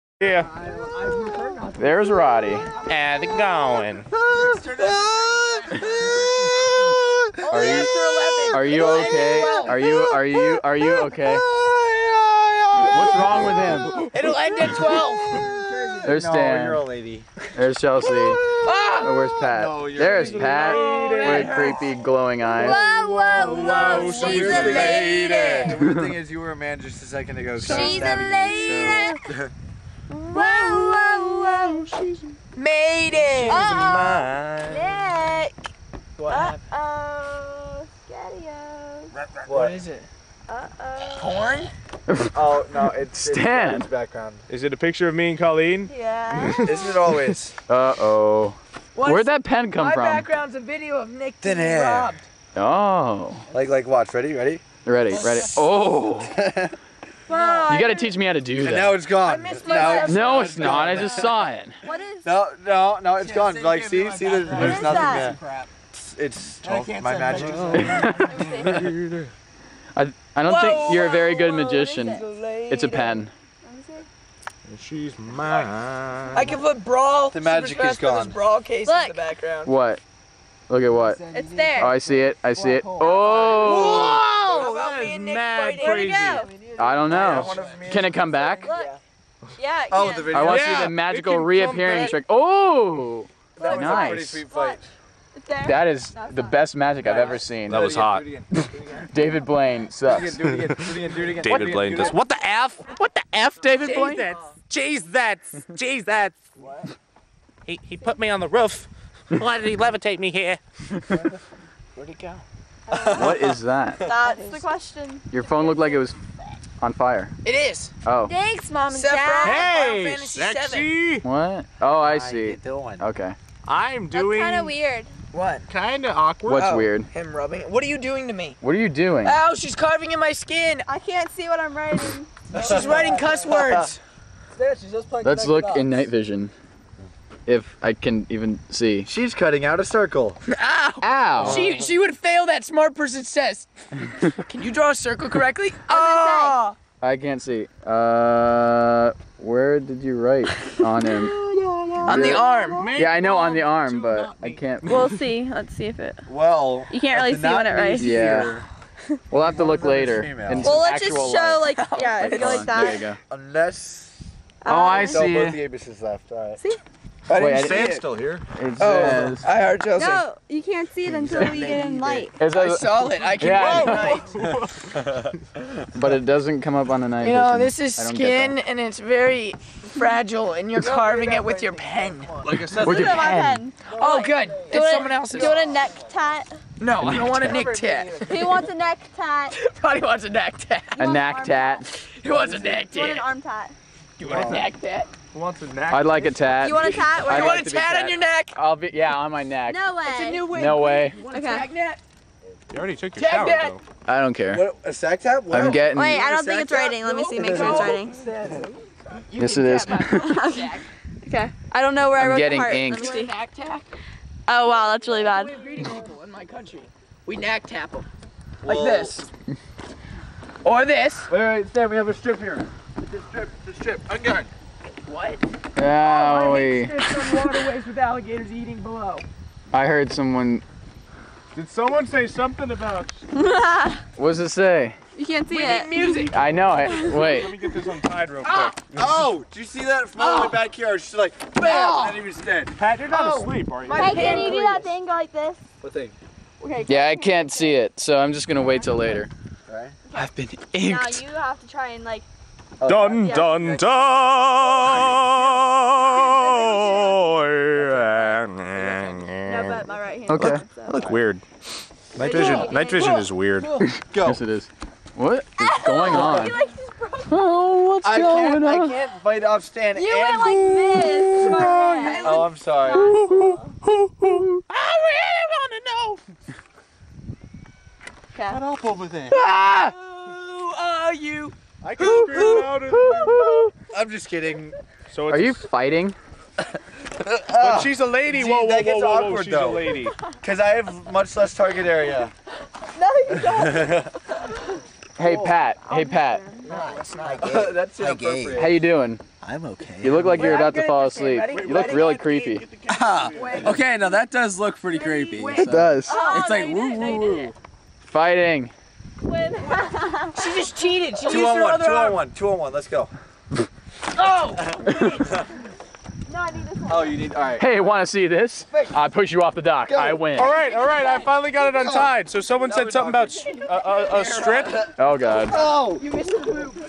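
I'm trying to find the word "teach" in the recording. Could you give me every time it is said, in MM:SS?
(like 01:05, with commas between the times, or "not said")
00:57.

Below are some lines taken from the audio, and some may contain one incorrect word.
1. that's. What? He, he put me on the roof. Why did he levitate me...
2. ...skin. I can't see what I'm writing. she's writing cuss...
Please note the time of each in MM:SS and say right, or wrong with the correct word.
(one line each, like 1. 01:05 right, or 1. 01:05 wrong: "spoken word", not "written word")
1. 01:46 right
2. 02:10 right.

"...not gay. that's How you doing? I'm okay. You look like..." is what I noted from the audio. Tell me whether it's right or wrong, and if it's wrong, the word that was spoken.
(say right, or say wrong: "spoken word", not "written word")
right.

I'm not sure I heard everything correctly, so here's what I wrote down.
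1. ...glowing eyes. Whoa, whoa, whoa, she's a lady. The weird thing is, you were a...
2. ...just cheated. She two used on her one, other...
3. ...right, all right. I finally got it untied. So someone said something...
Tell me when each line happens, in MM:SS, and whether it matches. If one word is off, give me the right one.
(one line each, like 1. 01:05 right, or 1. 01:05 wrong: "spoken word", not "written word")
1. 00:21 right
2. 05:10 right
3. 05:20 right.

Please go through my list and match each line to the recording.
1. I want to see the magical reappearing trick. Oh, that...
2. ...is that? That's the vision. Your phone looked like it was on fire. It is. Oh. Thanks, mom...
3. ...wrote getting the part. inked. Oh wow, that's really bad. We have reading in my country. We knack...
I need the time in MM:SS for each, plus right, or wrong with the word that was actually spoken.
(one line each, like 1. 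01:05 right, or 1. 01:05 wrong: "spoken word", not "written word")
1. 01:30 right
2. 01:53 wrong: "question", not "vision"
3. 03:32 right.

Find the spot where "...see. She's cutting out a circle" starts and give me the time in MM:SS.
02:18.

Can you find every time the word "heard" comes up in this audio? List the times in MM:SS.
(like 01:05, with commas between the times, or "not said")
02:49, 03:49.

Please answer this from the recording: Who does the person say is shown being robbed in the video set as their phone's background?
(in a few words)
Nick Thin.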